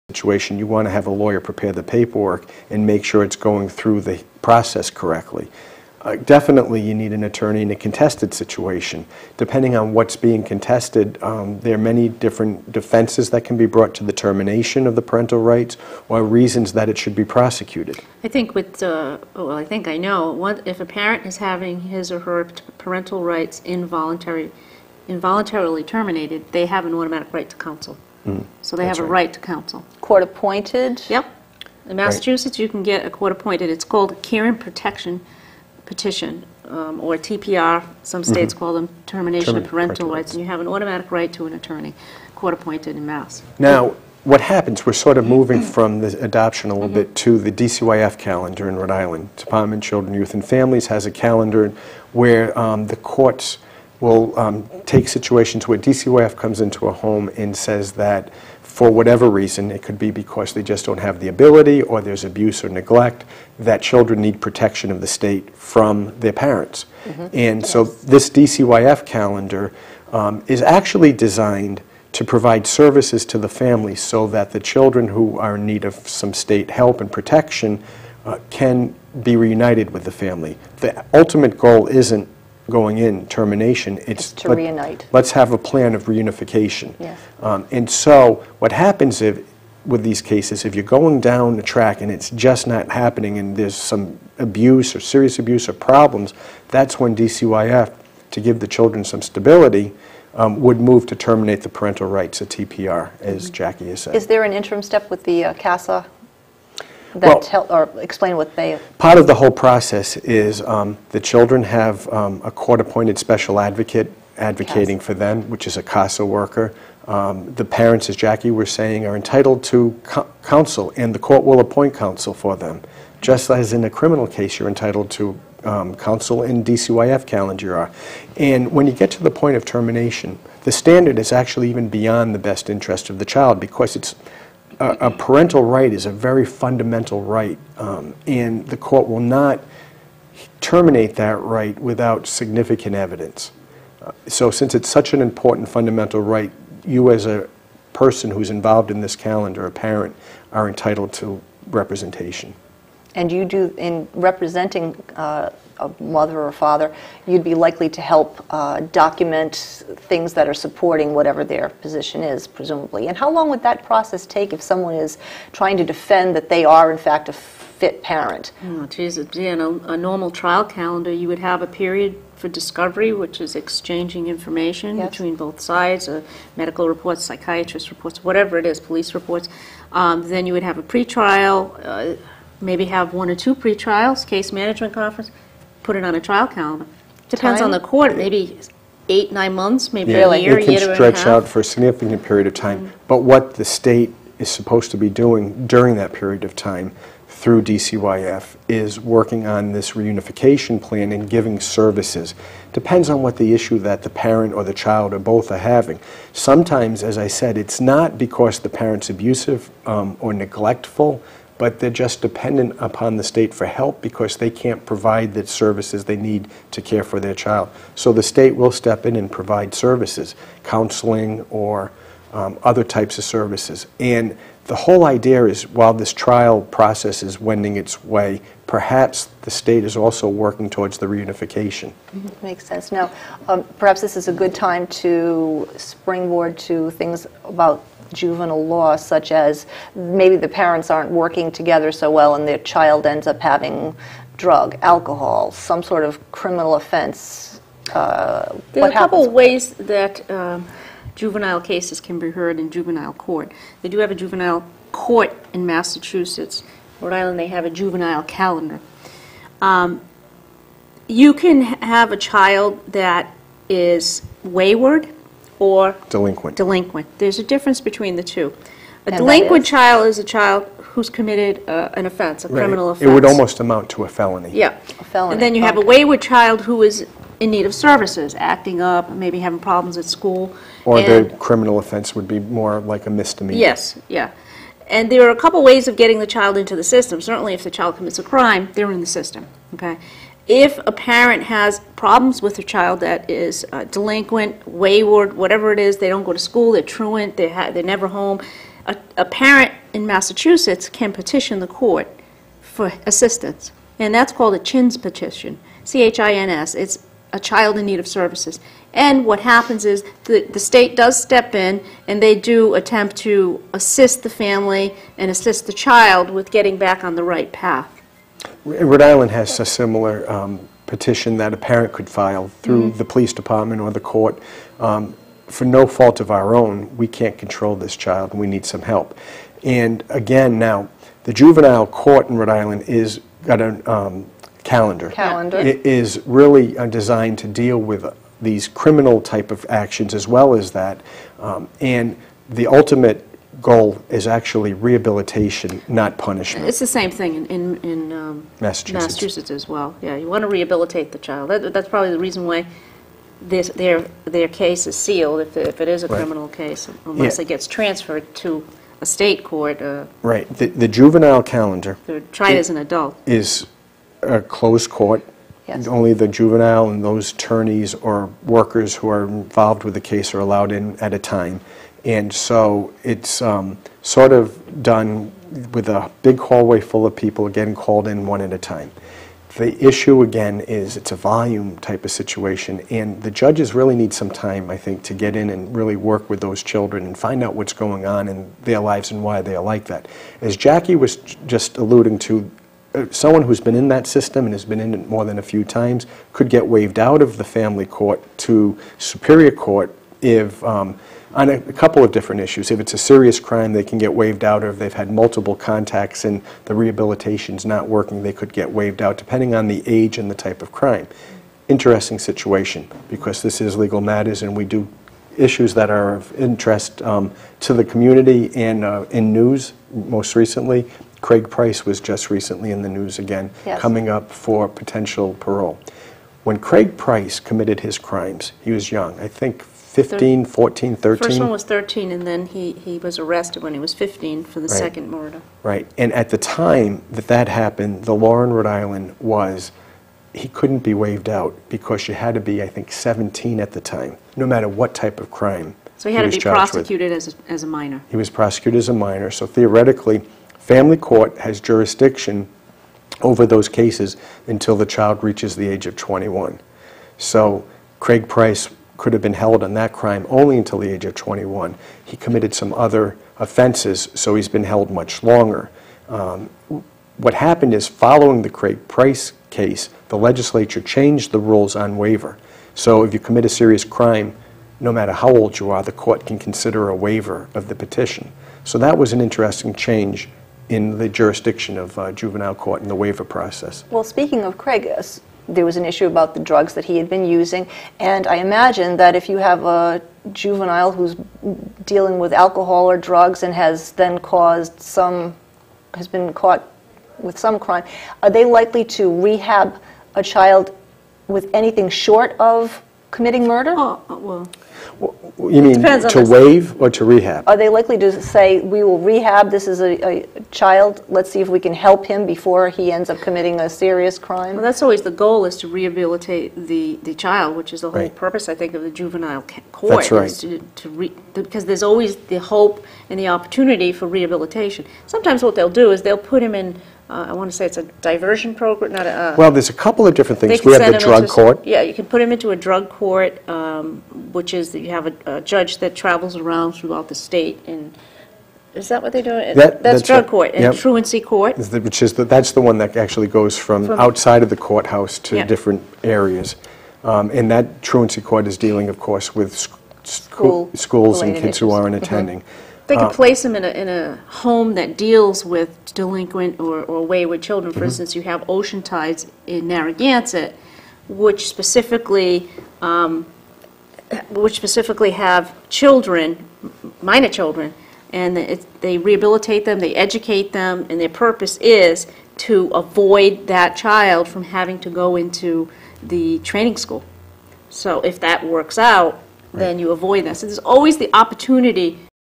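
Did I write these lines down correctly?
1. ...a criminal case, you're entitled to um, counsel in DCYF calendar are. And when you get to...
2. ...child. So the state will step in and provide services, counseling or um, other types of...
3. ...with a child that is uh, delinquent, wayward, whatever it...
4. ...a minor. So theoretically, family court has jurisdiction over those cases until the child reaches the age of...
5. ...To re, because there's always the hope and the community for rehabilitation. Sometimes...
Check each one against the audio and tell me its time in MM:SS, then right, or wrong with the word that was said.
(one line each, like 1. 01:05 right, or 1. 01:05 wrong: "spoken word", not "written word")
1. 02:03 right
2. 03:37 right
3. 04:52 right
4. 07:28 right
5. 08:40 wrong: "opportunity", not "community".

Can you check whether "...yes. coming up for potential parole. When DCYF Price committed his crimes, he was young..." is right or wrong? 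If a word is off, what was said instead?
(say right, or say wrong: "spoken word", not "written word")
wrong: "Craig", not "DCYF".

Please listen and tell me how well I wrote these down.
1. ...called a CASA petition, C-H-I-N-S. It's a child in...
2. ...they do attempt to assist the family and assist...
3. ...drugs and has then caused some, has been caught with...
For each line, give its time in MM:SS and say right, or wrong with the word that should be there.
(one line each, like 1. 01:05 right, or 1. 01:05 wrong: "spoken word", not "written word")
1. 05:04 wrong: "CHINS", not "CASA"
2. 05:12 right
3. 08:12 right.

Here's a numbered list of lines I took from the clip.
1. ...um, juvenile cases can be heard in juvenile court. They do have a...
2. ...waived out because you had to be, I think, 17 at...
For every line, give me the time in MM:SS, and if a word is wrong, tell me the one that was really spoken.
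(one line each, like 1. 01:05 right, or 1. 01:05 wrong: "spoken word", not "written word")
1. 04:10 right
2. 07:20 right.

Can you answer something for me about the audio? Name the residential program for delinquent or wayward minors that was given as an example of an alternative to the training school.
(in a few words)
Ocean Tides.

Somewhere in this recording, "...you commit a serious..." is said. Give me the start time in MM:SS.
07:53.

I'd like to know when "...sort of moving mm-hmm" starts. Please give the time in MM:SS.
00:44.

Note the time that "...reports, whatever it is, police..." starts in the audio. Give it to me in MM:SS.
02:57.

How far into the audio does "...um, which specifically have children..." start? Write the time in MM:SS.
09:22.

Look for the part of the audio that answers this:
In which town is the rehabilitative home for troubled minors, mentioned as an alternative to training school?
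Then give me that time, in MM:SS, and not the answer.
09:19.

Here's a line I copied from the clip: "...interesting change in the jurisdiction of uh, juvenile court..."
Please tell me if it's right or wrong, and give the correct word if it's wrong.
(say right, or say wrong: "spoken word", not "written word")
right.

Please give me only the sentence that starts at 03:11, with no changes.
out for a significant period of time.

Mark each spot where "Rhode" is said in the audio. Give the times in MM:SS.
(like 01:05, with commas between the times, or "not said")
00:48, 04:17, 05:18, 05:32, 07:18.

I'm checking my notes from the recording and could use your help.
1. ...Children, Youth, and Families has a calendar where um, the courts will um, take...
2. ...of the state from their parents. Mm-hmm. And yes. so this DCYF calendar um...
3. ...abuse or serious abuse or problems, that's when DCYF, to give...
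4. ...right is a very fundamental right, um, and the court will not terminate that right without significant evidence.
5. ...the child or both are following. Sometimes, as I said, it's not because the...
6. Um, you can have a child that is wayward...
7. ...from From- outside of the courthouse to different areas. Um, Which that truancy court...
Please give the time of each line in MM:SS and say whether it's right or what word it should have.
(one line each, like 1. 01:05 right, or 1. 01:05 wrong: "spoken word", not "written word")
1. 00:49 right
2. 01:04 right
3. 01:34 right
4. 02:15 right
5. 03:24 wrong: "having", not "following"
6. 04:19 right
7. 09:03 wrong: "And", not "Which".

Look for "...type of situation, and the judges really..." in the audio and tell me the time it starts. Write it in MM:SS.
06:21.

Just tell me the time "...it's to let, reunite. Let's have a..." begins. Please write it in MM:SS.
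01:24.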